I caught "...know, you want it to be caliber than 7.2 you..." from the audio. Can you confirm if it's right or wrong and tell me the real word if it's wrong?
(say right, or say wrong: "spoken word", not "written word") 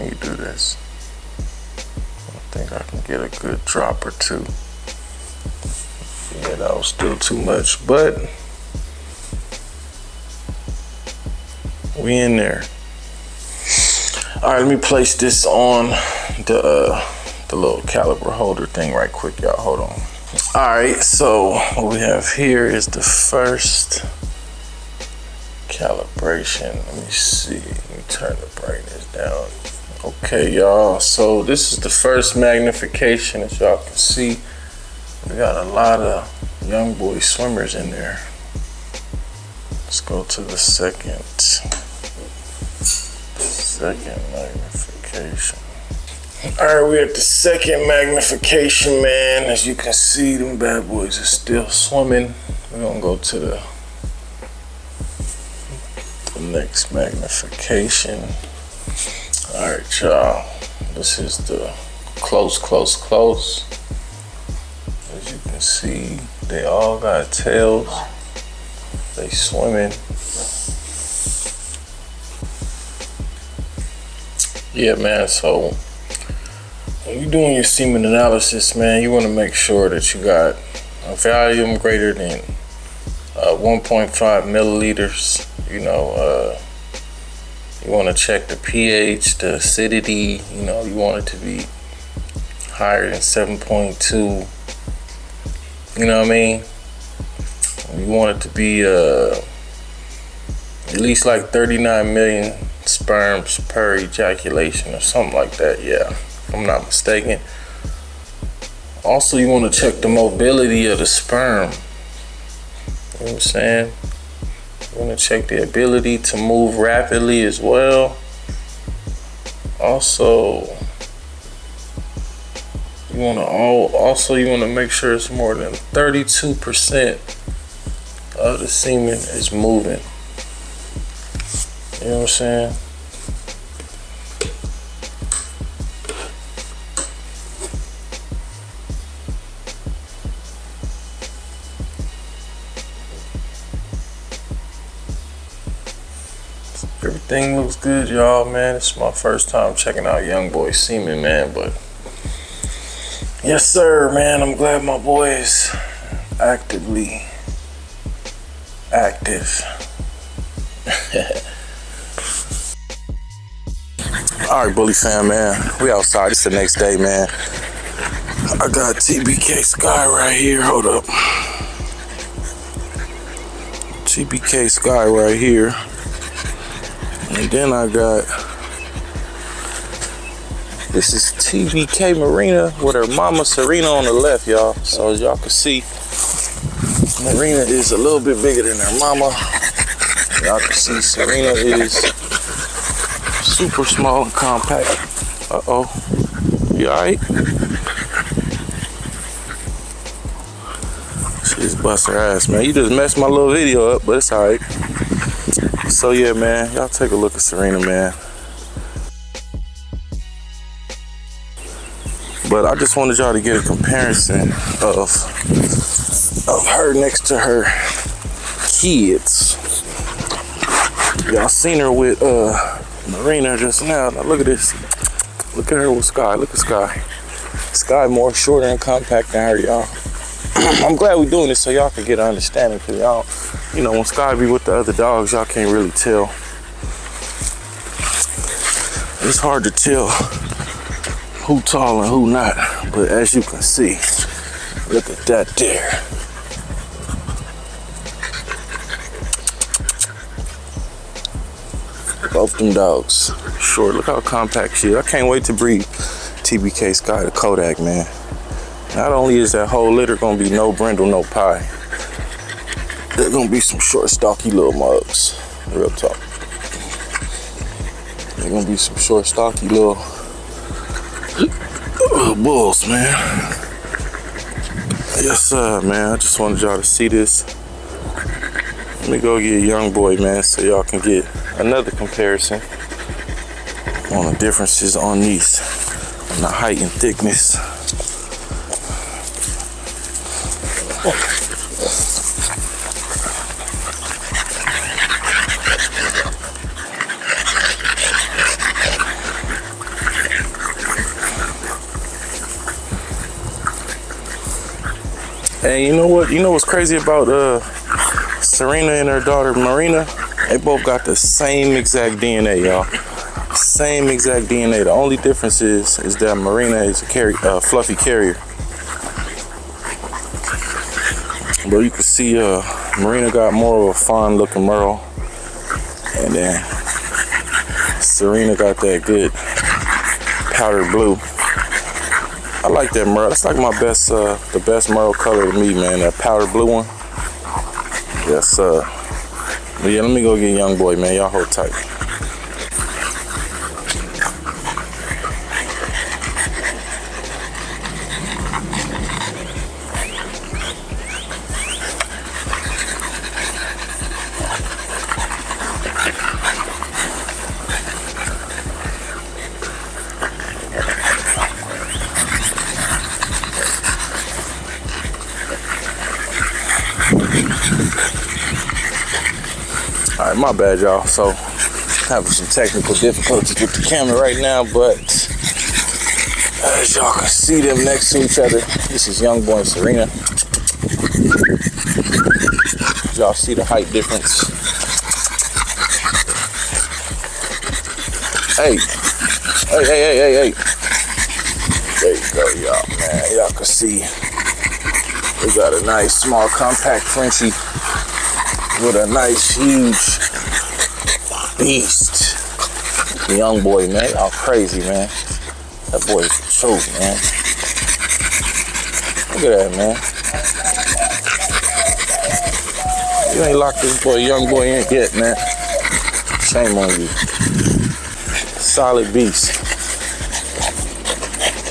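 wrong: "higher", not "caliber".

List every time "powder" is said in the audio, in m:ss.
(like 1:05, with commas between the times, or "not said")
5:30, 5:36.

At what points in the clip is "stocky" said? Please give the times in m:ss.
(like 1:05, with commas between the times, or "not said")
4:24, 4:29.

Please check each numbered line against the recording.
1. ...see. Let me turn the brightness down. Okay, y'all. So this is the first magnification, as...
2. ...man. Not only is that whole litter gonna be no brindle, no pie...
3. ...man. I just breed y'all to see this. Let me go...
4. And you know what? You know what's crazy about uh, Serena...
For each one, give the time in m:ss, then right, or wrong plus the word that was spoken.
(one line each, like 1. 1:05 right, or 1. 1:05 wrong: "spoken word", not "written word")
1. 0:27 right
2. 4:17 right
3. 4:35 wrong: "wanted", not "breed"
4. 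5:05 right.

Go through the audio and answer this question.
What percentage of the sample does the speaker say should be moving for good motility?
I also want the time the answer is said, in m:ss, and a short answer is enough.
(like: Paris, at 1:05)
32%, at 2:05.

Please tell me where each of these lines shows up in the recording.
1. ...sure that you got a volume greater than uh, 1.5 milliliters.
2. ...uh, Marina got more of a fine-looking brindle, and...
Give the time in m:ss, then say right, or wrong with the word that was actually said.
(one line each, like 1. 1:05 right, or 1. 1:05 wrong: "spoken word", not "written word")
1. 1:19 right
2. 5:22 wrong: "merle", not "brindle".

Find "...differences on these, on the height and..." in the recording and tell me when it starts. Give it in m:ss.
4:44.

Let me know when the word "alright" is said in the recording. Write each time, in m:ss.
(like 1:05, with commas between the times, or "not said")
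3:16, 3:24.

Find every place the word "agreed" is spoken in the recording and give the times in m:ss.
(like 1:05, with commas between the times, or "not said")
not said.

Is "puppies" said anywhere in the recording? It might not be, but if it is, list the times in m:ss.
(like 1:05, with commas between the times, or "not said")
not said.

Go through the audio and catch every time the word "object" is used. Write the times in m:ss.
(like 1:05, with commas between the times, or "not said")
not said.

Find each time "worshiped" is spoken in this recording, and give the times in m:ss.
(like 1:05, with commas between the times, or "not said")
not said.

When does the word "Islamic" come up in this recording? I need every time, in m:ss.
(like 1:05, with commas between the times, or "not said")
not said.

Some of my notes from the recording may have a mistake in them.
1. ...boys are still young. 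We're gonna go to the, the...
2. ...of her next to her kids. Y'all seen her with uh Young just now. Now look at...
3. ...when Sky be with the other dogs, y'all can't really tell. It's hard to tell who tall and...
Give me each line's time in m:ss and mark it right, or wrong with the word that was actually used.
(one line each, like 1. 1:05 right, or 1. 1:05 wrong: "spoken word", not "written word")
1. 0:50 wrong: "swimming", not "young"
2. 3:36 wrong: "Marina", not "Young"
3. 3:53 right.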